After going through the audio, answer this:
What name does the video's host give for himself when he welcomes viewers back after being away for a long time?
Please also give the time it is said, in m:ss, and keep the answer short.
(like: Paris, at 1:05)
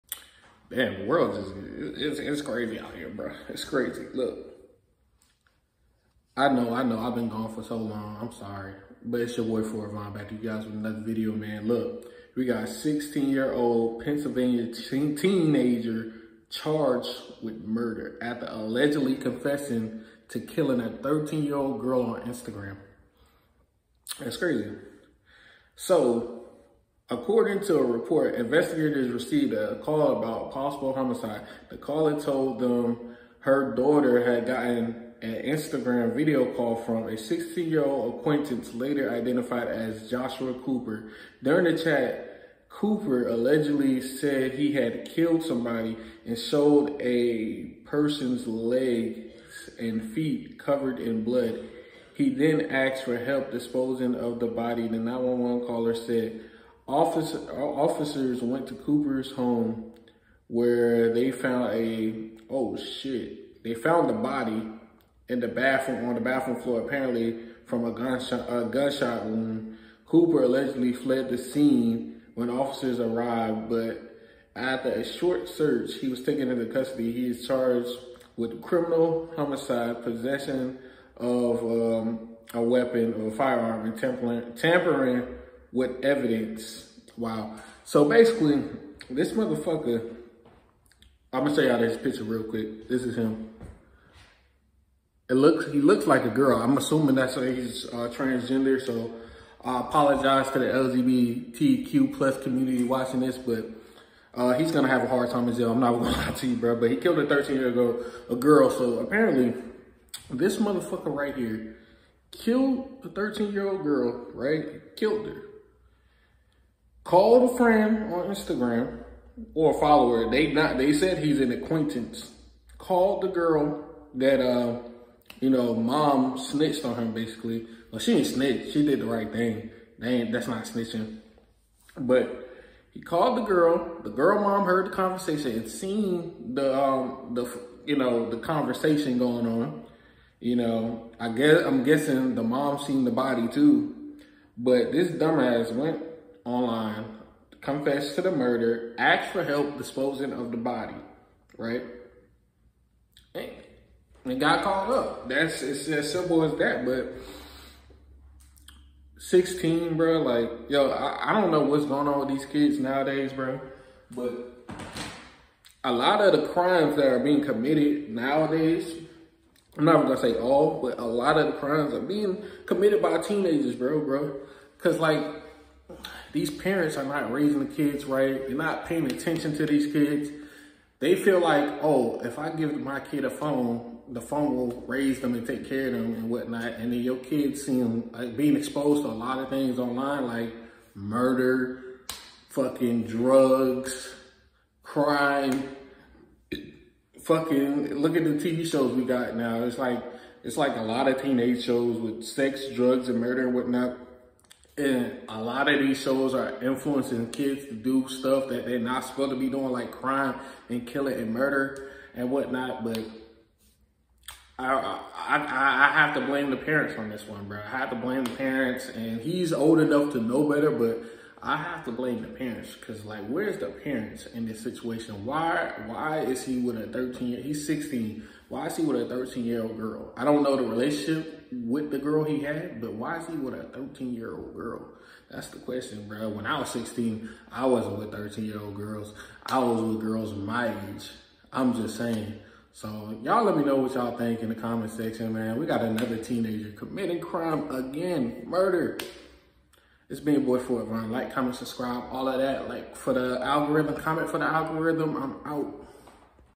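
Ford, at 0:09.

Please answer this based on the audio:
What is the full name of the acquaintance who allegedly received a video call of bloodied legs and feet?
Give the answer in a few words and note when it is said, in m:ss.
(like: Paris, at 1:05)
Joshua Cooper, at 0:40.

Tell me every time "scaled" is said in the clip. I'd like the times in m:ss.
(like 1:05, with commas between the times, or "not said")
not said.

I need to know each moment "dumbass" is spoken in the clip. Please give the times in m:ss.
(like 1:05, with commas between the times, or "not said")
2:25.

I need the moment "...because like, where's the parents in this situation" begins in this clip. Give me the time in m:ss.
3:42.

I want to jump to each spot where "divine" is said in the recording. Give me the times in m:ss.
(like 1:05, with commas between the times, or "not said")
not said.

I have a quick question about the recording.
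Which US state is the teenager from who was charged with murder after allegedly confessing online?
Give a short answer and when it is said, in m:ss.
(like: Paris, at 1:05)
Pennsylvania, at 0:14.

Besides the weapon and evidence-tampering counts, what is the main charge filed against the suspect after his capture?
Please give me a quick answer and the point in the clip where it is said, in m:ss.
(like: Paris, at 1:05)
Criminal homicide, at 1:18.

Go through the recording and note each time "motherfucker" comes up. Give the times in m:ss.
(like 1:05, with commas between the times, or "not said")
1:29, 1:50.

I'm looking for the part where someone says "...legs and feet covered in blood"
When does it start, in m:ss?
0:48.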